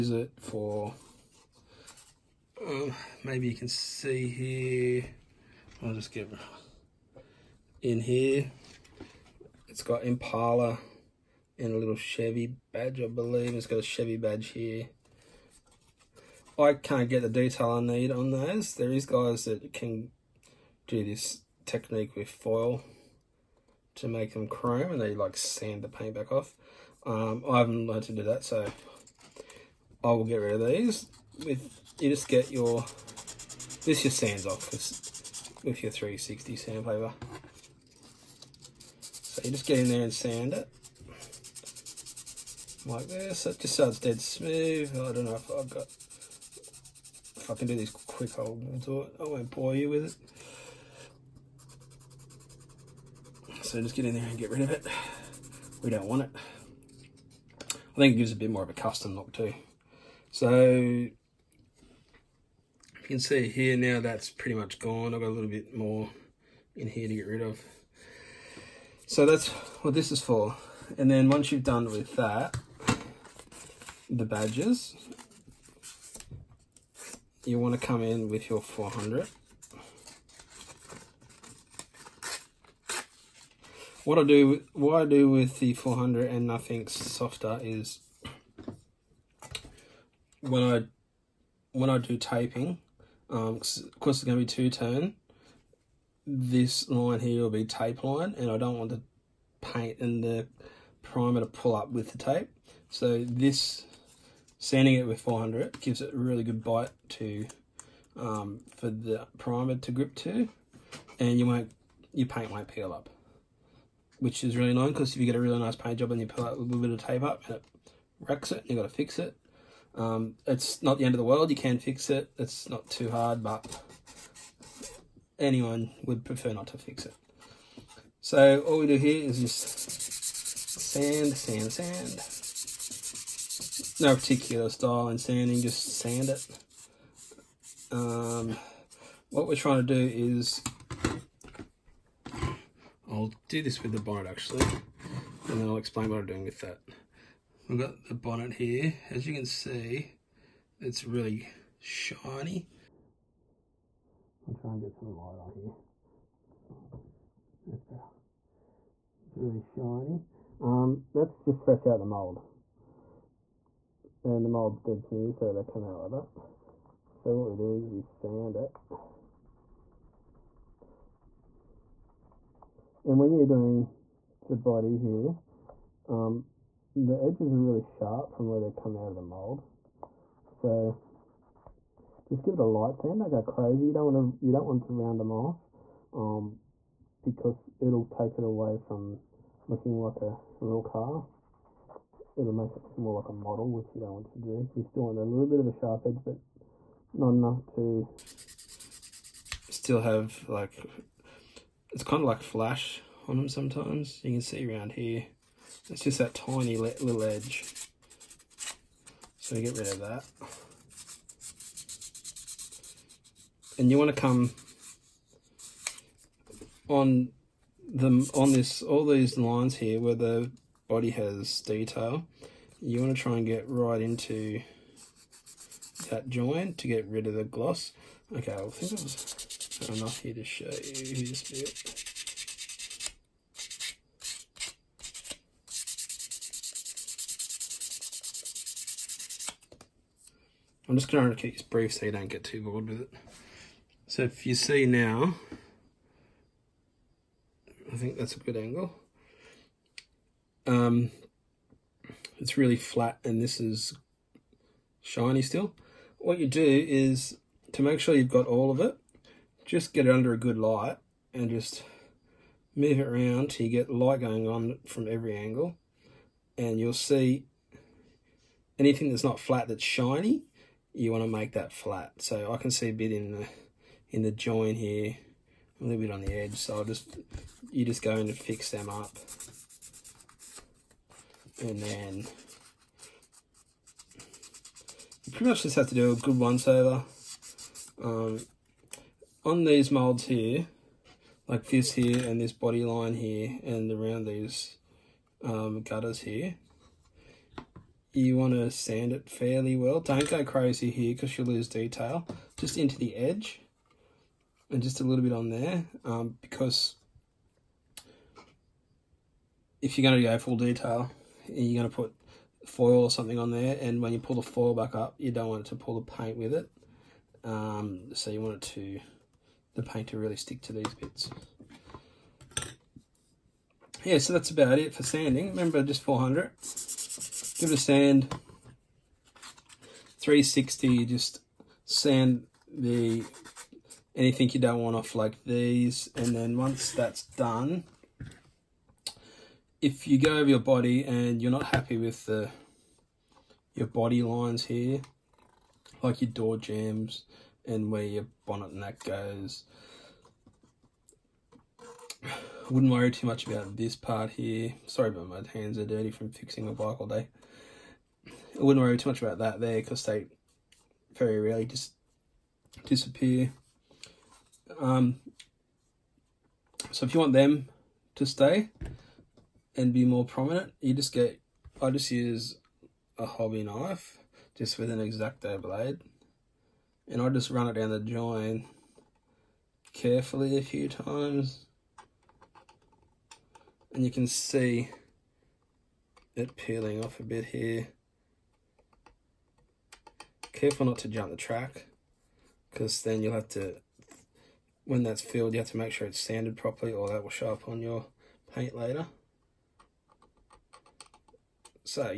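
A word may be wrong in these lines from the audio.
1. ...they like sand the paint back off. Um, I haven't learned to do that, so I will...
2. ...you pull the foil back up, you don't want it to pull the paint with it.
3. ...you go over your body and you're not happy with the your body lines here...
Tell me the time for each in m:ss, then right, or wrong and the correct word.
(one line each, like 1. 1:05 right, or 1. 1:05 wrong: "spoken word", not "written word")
1. 0:25 right
2. 5:14 right
3. 5:40 right.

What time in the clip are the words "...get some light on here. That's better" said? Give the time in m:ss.
2:34.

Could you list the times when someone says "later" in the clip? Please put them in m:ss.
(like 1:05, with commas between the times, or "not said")
6:38.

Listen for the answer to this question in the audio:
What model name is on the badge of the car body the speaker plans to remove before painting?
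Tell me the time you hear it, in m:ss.
0:10.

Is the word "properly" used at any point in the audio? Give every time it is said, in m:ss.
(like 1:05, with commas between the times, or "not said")
6:36.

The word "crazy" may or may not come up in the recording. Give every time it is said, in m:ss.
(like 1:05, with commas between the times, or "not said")
3:03, 5:00.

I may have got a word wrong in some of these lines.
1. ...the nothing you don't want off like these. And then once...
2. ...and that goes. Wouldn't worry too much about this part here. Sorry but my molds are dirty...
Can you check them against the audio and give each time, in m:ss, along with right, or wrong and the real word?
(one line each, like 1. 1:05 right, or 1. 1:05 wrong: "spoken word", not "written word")
1. 5:32 wrong: "anything", not "nothing"
2. 5:48 wrong: "hands", not "molds".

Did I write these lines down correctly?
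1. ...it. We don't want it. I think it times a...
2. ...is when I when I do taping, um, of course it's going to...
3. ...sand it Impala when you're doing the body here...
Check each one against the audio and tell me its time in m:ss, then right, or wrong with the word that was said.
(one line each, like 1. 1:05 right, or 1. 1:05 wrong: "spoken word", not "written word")
1. 0:54 wrong: "gives", not "times"
2. 1:27 right
3. 2:48 wrong: "And", not "Impala".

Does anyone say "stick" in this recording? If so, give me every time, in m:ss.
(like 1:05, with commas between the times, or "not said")
5:20.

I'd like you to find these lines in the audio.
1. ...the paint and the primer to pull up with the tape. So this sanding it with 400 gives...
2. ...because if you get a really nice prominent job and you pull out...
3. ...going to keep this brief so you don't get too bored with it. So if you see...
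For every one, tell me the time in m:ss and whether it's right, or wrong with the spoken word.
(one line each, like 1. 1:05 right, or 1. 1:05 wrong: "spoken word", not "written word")
1. 1:38 right
2. 1:54 wrong: "paint", not "prominent"
3. 4:01 right.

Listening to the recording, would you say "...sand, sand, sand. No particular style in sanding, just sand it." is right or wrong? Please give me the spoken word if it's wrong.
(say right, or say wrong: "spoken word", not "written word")
right.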